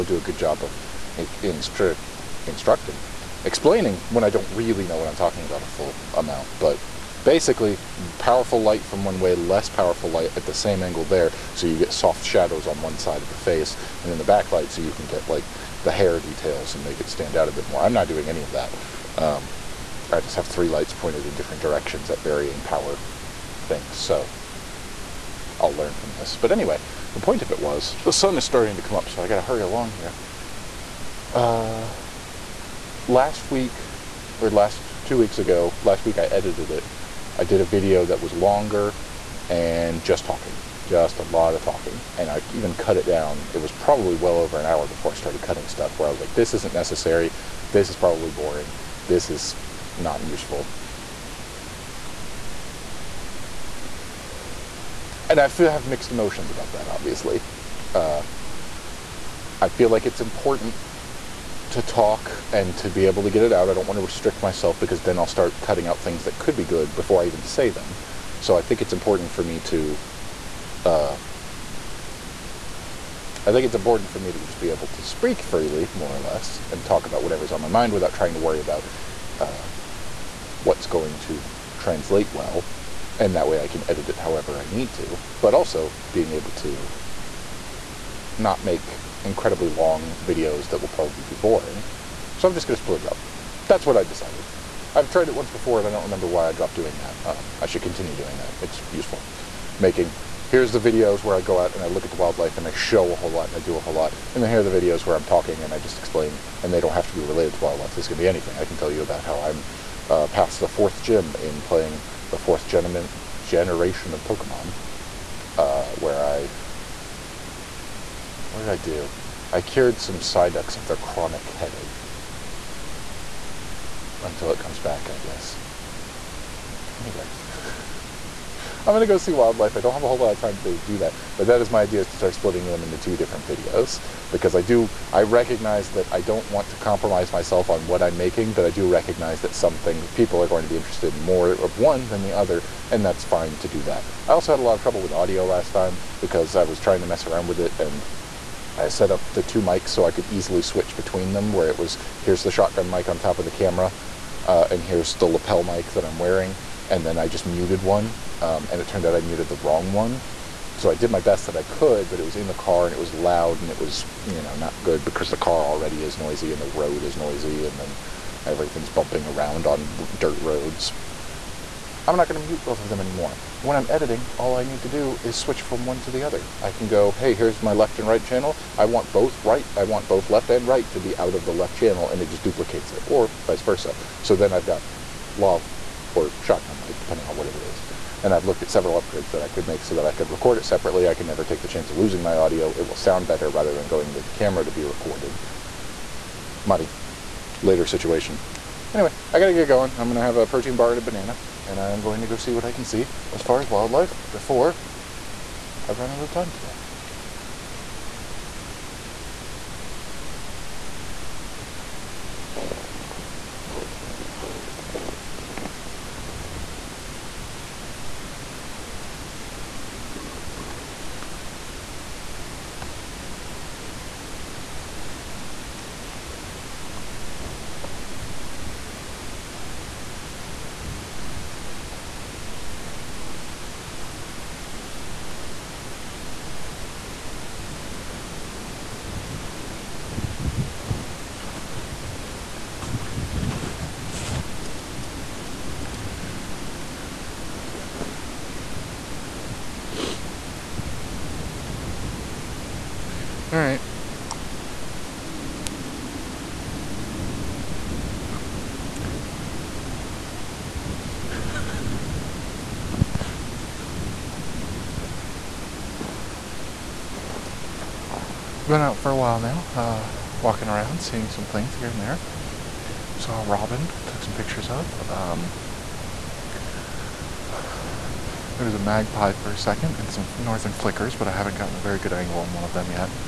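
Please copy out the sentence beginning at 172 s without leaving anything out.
I'm not going to mute both of them anymore.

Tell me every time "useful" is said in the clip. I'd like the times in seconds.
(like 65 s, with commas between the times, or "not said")
50 s, 98 s.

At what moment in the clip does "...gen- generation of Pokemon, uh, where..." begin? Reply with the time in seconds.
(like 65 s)
112 s.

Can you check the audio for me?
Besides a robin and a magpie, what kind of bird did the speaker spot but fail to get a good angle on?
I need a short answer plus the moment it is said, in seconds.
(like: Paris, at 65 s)
northern flickers, at 280 s.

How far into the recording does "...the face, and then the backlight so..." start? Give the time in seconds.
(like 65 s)
13 s.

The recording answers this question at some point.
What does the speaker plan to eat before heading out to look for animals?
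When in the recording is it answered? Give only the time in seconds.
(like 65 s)
200 s.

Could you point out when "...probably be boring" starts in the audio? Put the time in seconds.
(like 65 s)
90 s.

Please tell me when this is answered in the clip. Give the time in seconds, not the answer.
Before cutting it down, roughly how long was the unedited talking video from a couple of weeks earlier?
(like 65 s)
44 s.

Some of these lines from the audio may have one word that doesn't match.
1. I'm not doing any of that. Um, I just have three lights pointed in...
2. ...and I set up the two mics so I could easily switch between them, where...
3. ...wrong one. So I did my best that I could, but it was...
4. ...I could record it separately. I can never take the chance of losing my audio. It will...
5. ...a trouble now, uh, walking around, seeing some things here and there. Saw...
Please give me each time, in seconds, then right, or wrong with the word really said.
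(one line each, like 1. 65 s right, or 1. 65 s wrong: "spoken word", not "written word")
1. 17 s right
2. 147 s right
3. 159 s right
4. 190 s right
5. 269 s wrong: "while", not "trouble".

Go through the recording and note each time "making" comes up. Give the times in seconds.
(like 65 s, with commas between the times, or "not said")
99 s, 138 s.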